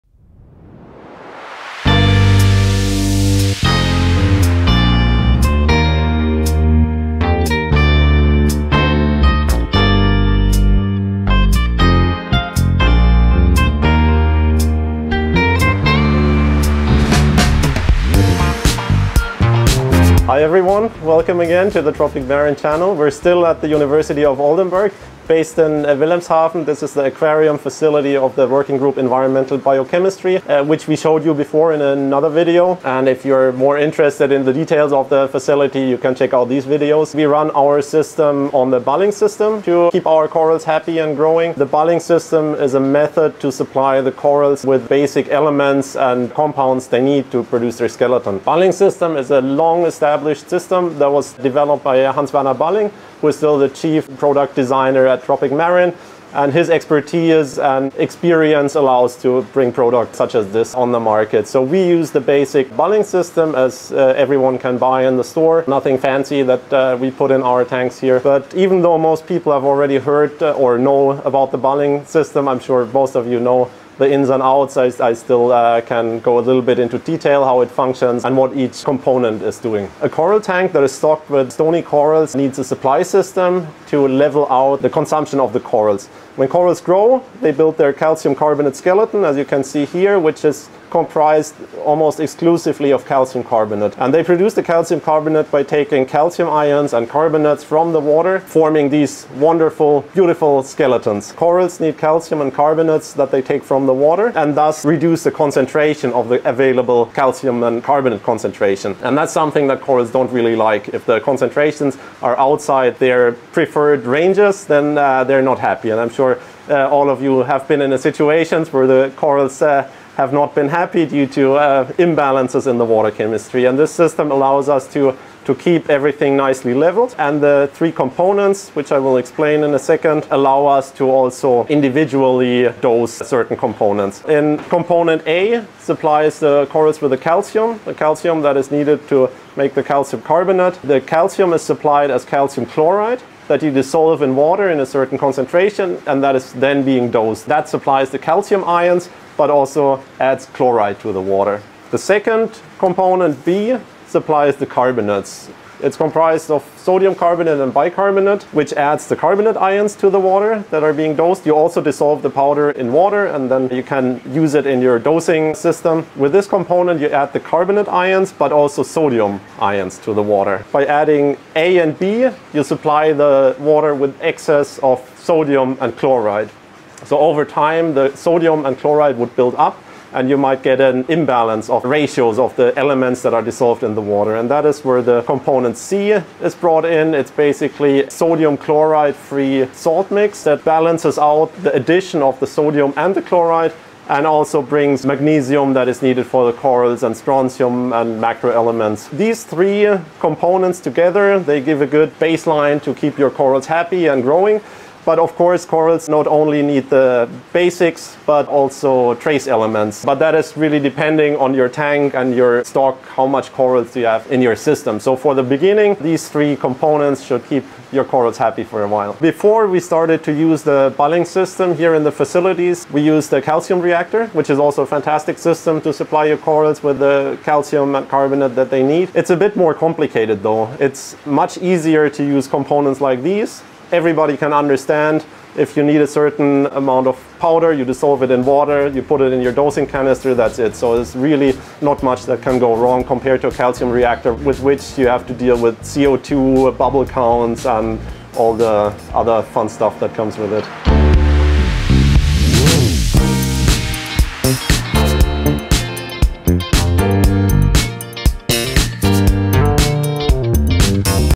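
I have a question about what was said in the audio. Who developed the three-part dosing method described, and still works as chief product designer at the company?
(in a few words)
Hans Werner Balling.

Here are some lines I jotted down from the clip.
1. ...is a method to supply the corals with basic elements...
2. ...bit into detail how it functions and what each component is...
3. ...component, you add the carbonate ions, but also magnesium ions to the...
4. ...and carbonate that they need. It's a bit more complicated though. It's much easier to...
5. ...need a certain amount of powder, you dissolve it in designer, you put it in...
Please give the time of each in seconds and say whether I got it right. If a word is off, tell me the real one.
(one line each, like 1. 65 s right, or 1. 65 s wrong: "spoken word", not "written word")
1. 42 s right
2. 76 s right
3. 166 s wrong: "sodium", not "magnesium"
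4. 227 s right
5. 235 s wrong: "water", not "designer".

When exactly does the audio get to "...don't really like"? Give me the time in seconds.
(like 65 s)
110 s.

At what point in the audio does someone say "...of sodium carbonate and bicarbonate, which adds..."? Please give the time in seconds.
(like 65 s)
156 s.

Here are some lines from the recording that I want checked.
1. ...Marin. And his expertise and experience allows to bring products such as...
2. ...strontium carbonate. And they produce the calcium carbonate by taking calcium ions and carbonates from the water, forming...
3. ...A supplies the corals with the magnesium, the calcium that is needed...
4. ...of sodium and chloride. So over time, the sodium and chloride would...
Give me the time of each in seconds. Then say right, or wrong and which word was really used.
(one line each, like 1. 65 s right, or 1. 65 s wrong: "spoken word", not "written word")
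1. 55 s right
2. 93 s wrong: "calcium", not "strontium"
3. 135 s wrong: "calcium", not "magnesium"
4. 174 s right.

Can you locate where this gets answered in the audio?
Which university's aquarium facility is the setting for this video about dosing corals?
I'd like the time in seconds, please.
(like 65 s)
23 s.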